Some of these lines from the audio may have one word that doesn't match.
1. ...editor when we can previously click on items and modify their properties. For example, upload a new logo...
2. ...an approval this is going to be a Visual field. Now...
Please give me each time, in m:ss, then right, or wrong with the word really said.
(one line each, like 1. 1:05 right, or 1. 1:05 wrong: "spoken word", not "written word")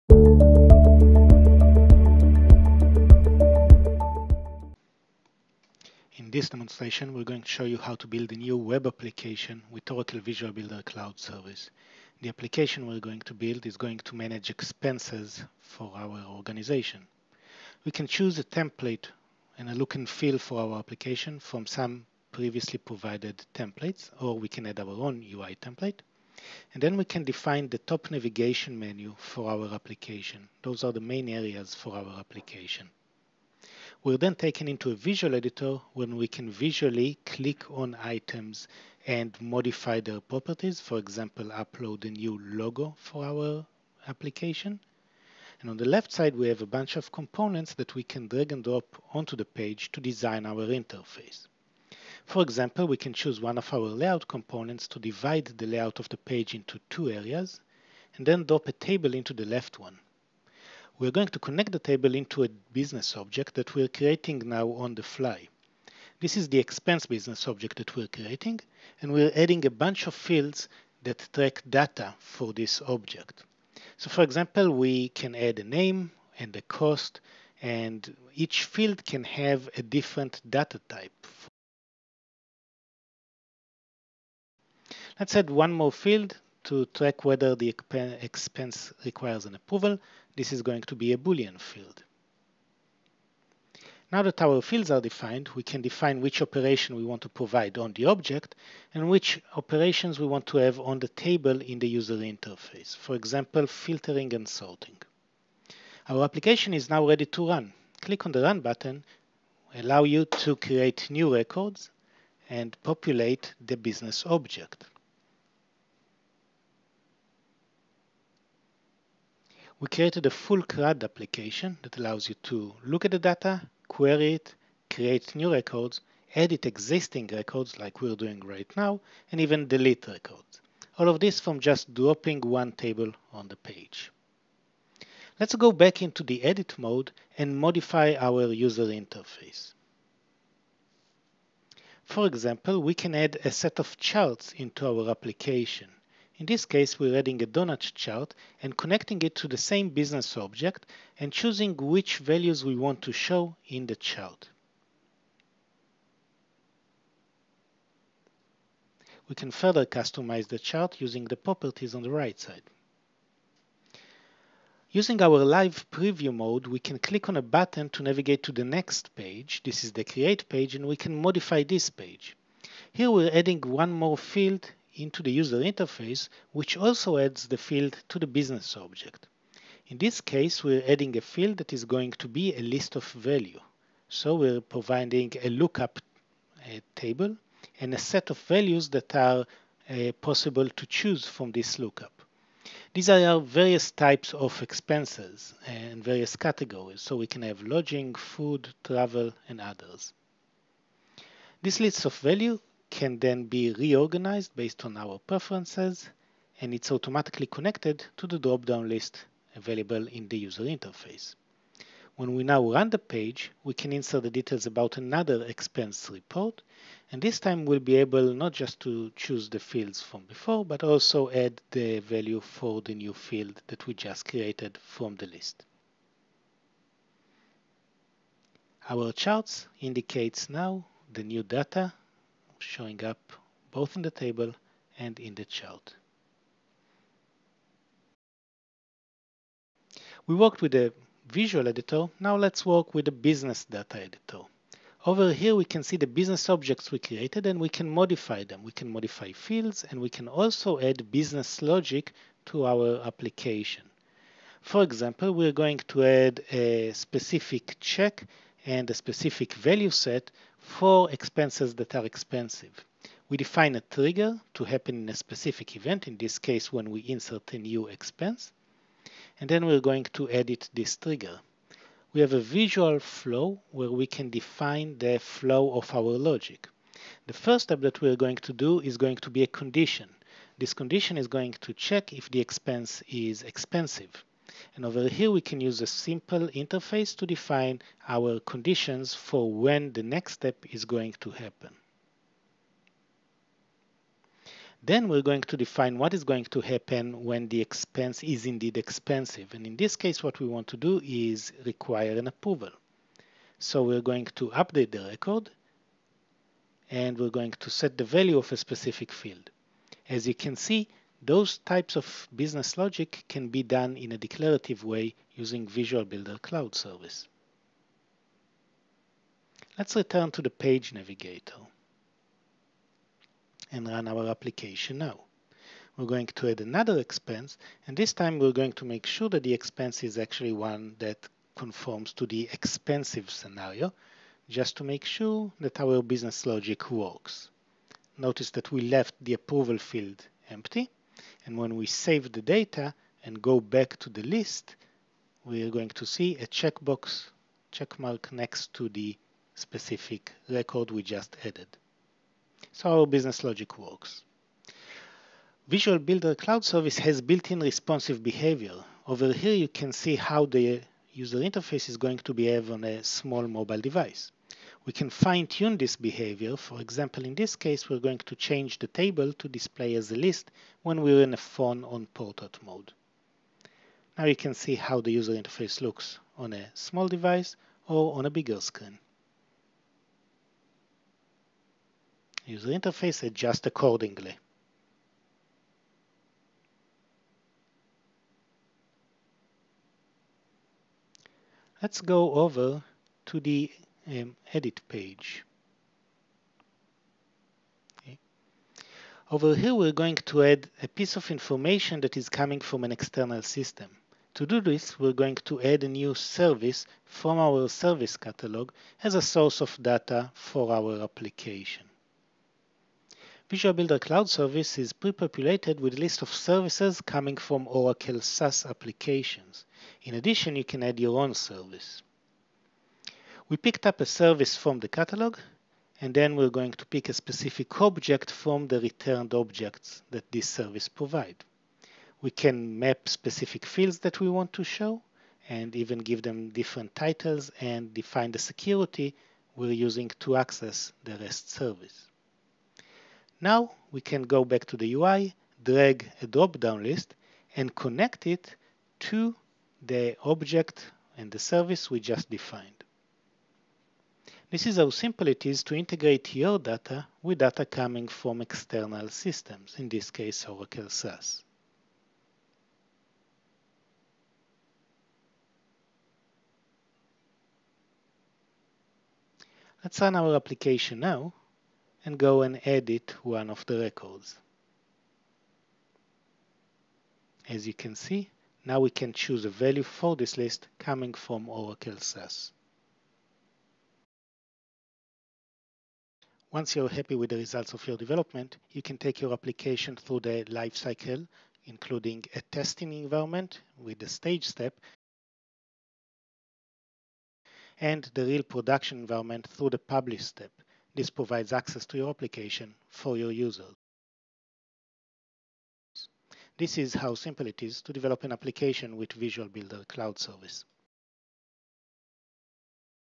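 1. 0:35 wrong: "visually", not "previously"
2. 1:29 wrong: "Boolean", not "Visual".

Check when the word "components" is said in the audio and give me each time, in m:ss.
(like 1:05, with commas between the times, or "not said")
0:47, 0:54.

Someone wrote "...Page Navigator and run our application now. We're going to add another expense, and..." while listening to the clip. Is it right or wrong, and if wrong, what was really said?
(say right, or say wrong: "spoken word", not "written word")
right.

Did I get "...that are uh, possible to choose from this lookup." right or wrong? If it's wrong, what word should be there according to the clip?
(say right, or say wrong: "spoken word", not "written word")
right.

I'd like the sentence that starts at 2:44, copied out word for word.
Using our live preview mode, we can click on a button to navigate to the next page.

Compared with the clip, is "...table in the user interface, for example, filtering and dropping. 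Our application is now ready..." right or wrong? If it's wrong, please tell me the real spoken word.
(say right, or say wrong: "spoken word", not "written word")
wrong: "sorting", not "dropping".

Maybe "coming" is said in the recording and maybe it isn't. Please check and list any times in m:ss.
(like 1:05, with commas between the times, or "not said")
6:42, 6:57, 7:37, 8:00.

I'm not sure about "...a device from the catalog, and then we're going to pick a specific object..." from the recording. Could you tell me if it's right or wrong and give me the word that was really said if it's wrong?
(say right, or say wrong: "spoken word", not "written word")
wrong: "service", not "device".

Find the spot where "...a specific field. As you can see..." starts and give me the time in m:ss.
5:08.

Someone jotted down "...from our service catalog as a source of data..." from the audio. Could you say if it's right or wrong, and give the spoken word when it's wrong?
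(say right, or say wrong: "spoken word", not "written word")
right.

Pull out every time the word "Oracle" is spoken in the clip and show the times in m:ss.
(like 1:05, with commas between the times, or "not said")
0:09, 6:57, 7:40, 8:01.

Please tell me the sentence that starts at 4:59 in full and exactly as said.
And in this case, what we want to do is require an approval.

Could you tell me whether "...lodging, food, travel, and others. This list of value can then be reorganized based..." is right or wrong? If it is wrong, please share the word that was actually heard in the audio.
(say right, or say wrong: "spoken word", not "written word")
right.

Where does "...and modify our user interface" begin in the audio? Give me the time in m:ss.
2:17.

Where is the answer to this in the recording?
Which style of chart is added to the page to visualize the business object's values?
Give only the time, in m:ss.
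2:27.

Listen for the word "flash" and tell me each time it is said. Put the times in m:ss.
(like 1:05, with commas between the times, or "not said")
not said.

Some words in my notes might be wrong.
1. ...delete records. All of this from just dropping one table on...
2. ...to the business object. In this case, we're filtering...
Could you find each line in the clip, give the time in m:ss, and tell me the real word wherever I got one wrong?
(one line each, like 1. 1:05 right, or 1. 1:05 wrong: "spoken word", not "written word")
1. 2:09 right
2. 2:58 wrong: "adding", not "filtering".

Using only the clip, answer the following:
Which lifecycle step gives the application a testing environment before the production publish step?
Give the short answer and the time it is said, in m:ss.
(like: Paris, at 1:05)
Stage, at 8:14.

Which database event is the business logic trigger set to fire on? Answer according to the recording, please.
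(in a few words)
Insert a new expense.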